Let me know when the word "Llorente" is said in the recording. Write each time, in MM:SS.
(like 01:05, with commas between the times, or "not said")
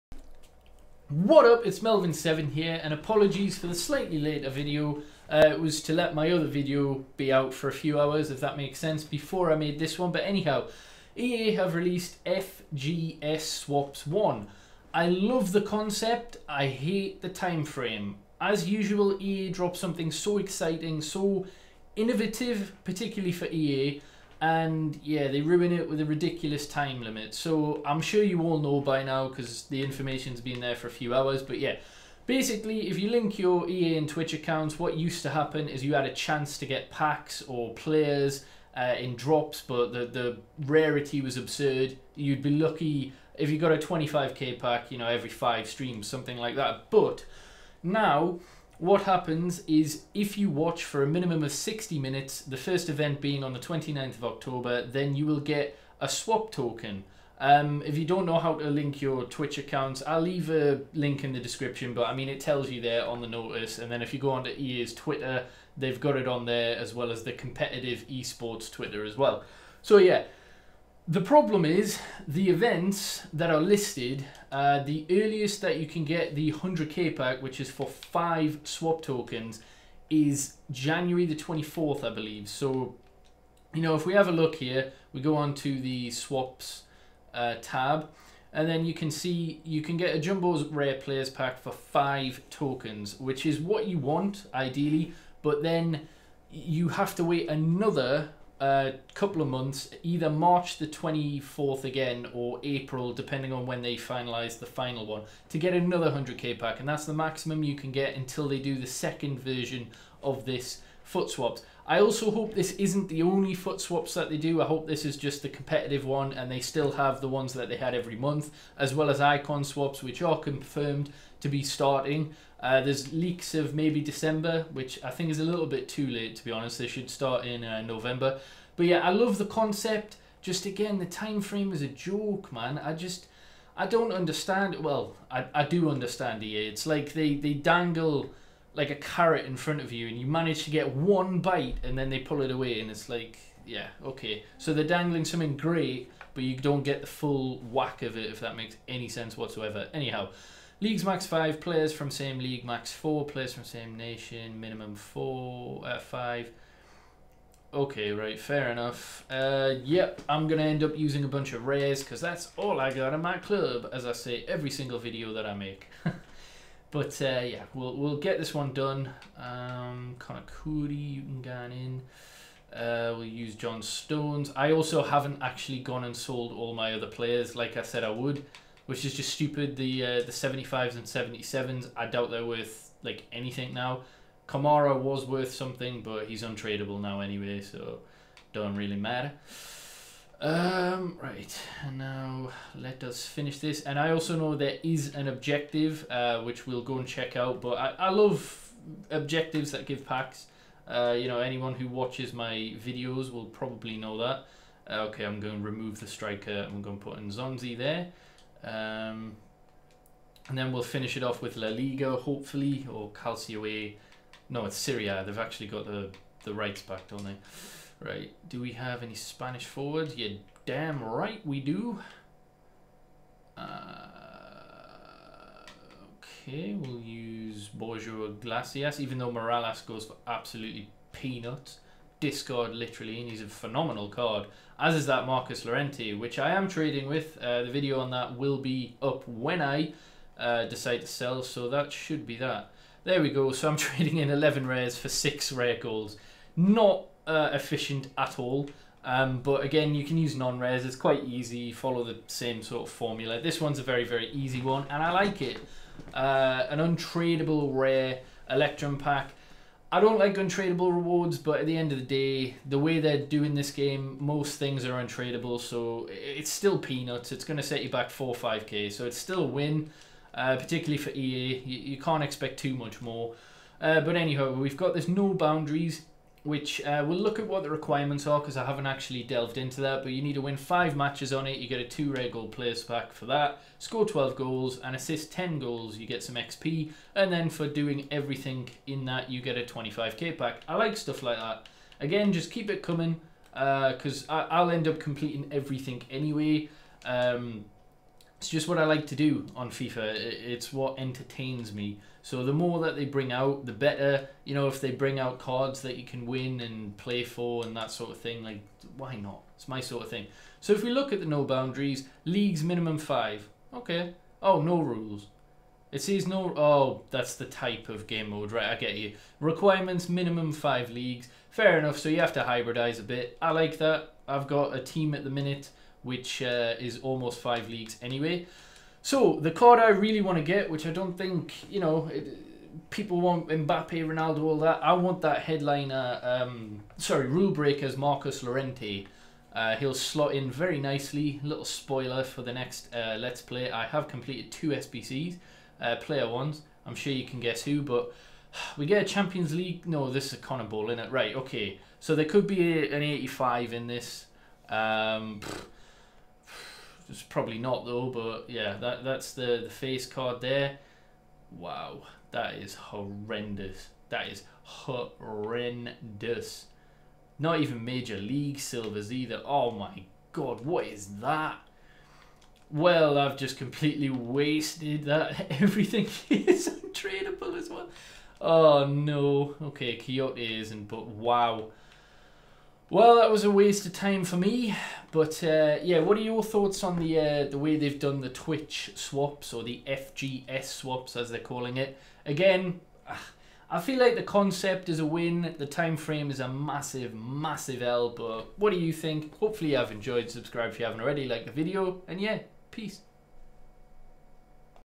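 03:55, 05:38.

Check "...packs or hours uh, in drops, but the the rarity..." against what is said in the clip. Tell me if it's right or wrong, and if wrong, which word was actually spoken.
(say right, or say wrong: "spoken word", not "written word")
wrong: "players", not "hours".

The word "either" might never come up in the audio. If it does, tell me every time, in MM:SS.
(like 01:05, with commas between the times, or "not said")
01:40, 06:09.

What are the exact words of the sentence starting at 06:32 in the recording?
Again, ah, I feel like the concept is a win.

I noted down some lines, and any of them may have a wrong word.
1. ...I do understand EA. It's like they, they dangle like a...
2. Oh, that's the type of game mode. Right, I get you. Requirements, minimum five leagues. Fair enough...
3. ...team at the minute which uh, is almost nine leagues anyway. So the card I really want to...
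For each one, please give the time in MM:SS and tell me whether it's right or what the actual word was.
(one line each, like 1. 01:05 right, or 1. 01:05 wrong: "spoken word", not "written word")
1. 02:15 right
2. 05:16 right
3. 05:24 wrong: "five", not "nine".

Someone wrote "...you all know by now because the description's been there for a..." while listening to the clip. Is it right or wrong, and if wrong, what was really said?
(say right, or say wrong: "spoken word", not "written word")
wrong: "information", not "description".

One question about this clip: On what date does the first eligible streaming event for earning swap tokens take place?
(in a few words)
29th of October.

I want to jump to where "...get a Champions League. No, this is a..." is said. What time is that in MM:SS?
05:48.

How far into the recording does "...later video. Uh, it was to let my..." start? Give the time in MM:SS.
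00:04.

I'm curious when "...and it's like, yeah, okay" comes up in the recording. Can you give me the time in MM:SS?
02:22.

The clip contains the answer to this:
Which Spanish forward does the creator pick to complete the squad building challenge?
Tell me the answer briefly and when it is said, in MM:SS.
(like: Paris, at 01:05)
Borja Iglesias, at 03:47.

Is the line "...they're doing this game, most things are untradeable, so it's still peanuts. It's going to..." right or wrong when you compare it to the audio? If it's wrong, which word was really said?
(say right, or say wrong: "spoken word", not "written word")
right.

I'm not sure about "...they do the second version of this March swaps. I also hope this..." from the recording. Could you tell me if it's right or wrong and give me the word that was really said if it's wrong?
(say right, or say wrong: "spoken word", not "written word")
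wrong: "FUT", not "March".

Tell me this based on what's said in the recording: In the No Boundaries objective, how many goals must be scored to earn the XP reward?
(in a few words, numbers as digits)
12.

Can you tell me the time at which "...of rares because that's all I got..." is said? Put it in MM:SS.
02:41.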